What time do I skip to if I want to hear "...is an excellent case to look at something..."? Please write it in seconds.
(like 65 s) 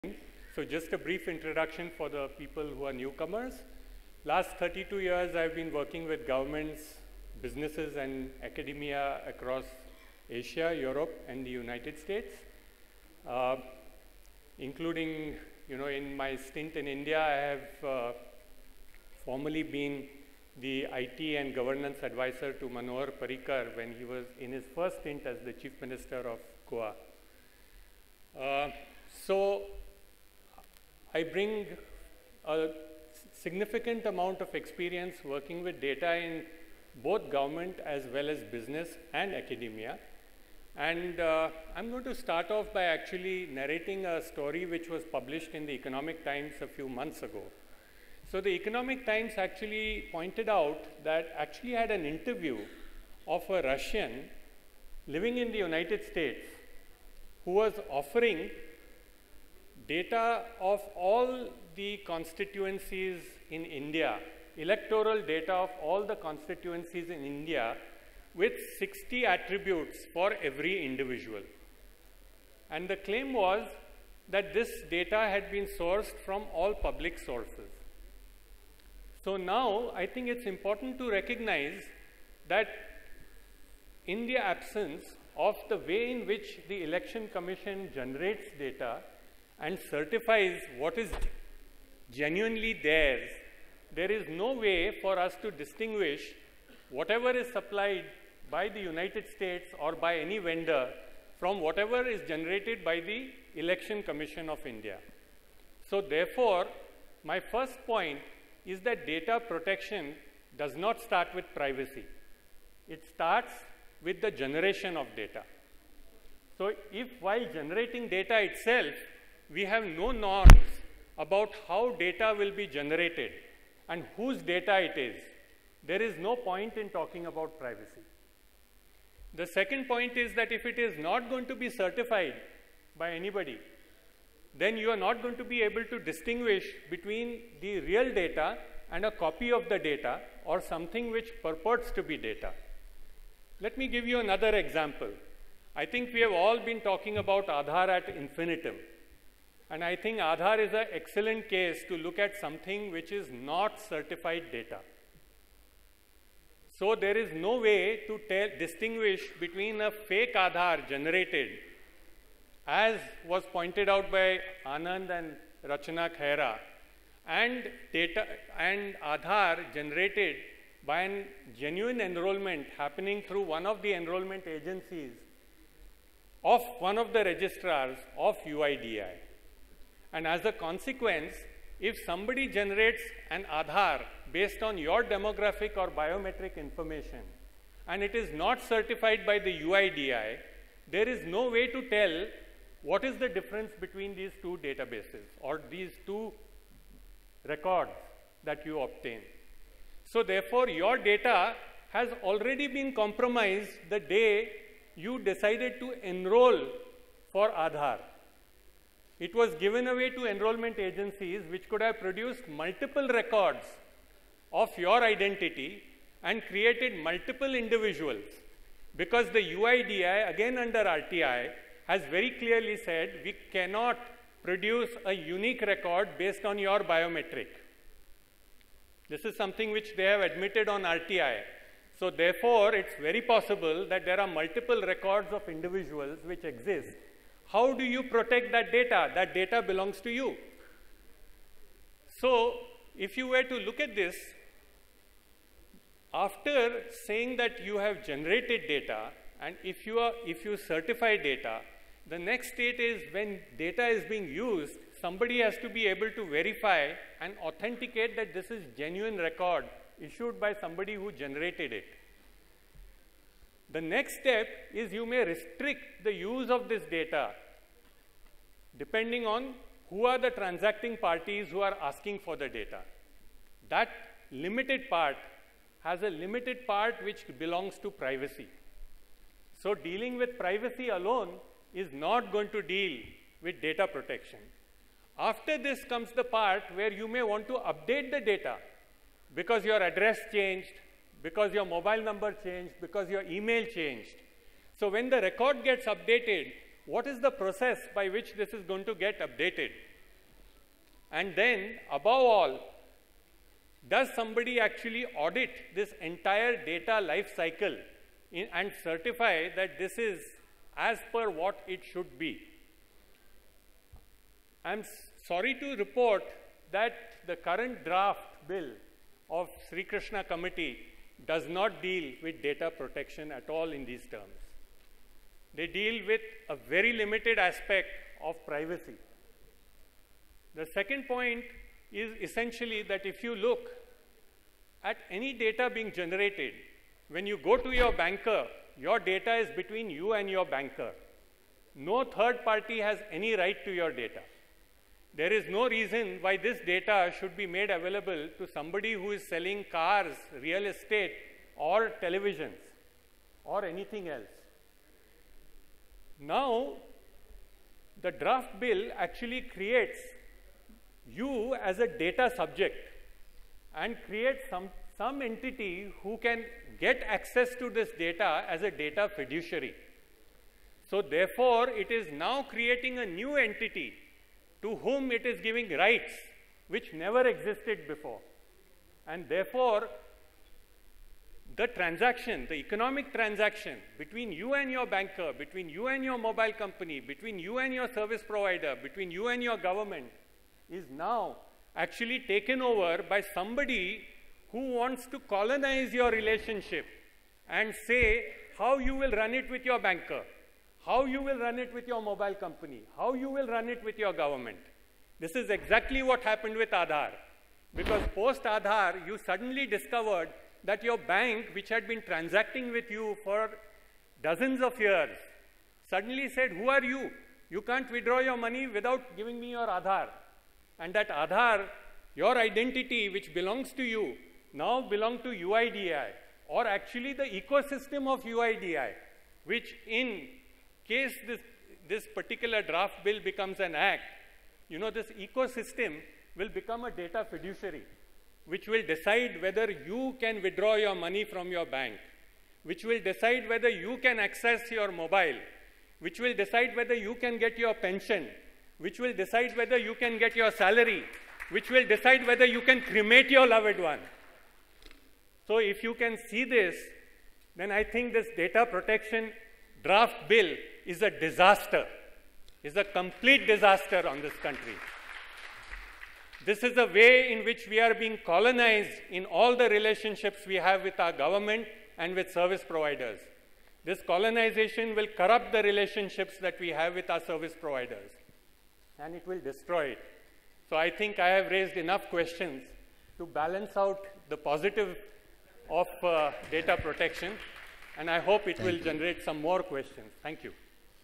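150 s.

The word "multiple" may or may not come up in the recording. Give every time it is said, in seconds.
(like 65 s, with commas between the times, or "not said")
212 s, 217 s, 234 s.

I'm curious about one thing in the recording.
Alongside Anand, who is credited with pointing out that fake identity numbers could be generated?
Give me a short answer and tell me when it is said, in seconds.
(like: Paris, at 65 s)
Rachna Khaira, at 165 s.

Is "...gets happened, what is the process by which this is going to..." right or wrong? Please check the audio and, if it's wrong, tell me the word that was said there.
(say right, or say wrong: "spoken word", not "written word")
wrong: "updated", not "happened".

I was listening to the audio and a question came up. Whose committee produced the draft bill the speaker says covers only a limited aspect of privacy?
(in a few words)
Srikrishna Committee.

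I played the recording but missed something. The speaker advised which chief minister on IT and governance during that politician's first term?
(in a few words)
Manohar Parrikar.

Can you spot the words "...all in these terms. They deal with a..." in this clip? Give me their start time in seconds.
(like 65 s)
323 s.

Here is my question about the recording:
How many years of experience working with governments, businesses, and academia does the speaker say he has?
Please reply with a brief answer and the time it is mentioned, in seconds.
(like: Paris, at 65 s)
32, at 4 s.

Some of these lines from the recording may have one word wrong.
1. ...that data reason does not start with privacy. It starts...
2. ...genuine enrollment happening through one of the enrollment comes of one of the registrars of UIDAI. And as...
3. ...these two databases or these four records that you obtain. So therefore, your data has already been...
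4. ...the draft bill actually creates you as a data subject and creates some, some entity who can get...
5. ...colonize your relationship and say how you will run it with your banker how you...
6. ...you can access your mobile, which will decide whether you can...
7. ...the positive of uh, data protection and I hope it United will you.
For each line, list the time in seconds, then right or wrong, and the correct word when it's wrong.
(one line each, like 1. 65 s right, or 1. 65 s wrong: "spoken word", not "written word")
1. 108 s wrong: "protection", not "reason"
2. 171 s wrong: "agencies", not "comes"
3. 194 s wrong: "two", not "four"
4. 358 s right
5. 395 s right
6. 443 s right
7. 484 s wrong: "Thank", not "United".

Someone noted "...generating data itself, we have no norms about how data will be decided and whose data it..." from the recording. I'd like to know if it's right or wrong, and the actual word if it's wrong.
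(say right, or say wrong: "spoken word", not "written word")
wrong: "generated", not "decided".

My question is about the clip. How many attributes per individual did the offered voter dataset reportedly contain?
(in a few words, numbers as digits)
60.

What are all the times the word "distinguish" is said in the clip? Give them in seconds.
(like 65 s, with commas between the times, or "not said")
95 s, 135 s, 158 s.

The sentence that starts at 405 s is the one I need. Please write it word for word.
This is exactly what happened with Aadhaar.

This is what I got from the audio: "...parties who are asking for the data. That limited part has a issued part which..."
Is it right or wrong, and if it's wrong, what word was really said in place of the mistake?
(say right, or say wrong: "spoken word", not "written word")
wrong: "limited", not "issued".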